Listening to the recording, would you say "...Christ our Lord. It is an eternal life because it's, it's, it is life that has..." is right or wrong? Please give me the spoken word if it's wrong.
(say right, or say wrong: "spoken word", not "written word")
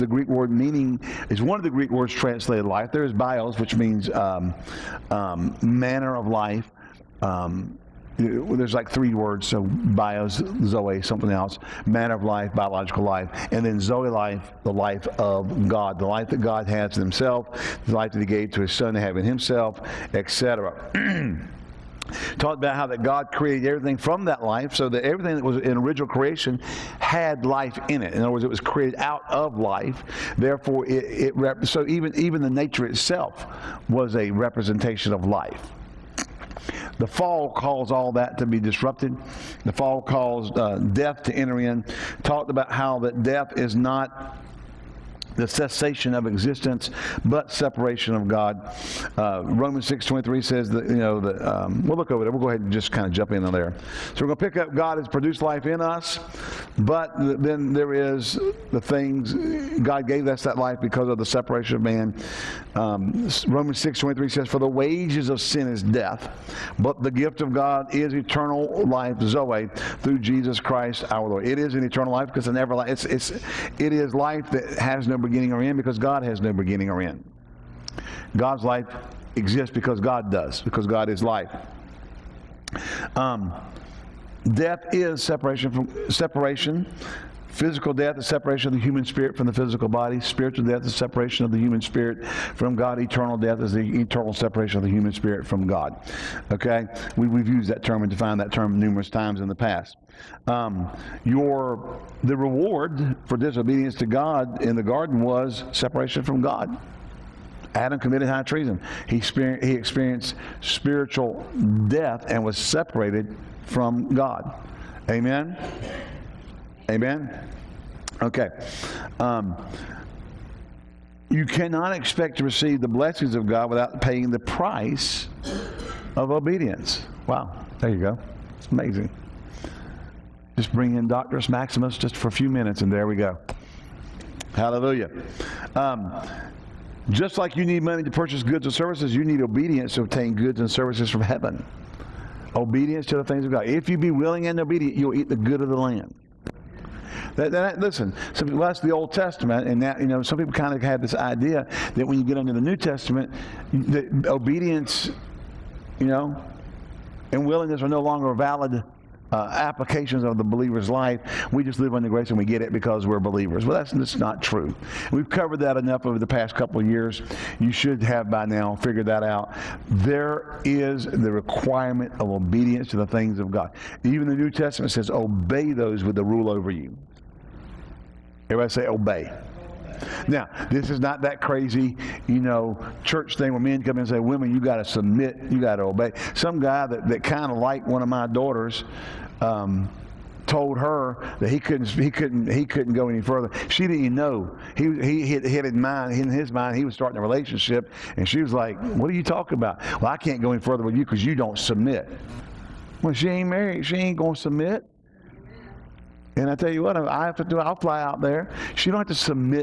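right.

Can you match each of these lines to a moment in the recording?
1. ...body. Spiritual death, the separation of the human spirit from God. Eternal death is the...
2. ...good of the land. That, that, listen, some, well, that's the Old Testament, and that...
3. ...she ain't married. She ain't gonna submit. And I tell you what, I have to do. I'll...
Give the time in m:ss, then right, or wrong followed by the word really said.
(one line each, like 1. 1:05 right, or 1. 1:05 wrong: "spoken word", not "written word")
1. 1:29 right
2. 2:25 right
3. 3:23 right.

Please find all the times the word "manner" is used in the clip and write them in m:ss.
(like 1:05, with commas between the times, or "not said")
0:05, 0:11.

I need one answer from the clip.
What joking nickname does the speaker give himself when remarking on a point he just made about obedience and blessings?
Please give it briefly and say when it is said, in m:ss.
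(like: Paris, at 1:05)
Doctorus Maximus, at 2:11.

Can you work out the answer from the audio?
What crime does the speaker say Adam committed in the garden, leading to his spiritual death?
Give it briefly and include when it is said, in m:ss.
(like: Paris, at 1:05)
High treason, at 1:48.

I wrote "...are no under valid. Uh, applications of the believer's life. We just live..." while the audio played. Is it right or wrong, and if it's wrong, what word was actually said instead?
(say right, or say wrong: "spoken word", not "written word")
wrong: "longer", not "under".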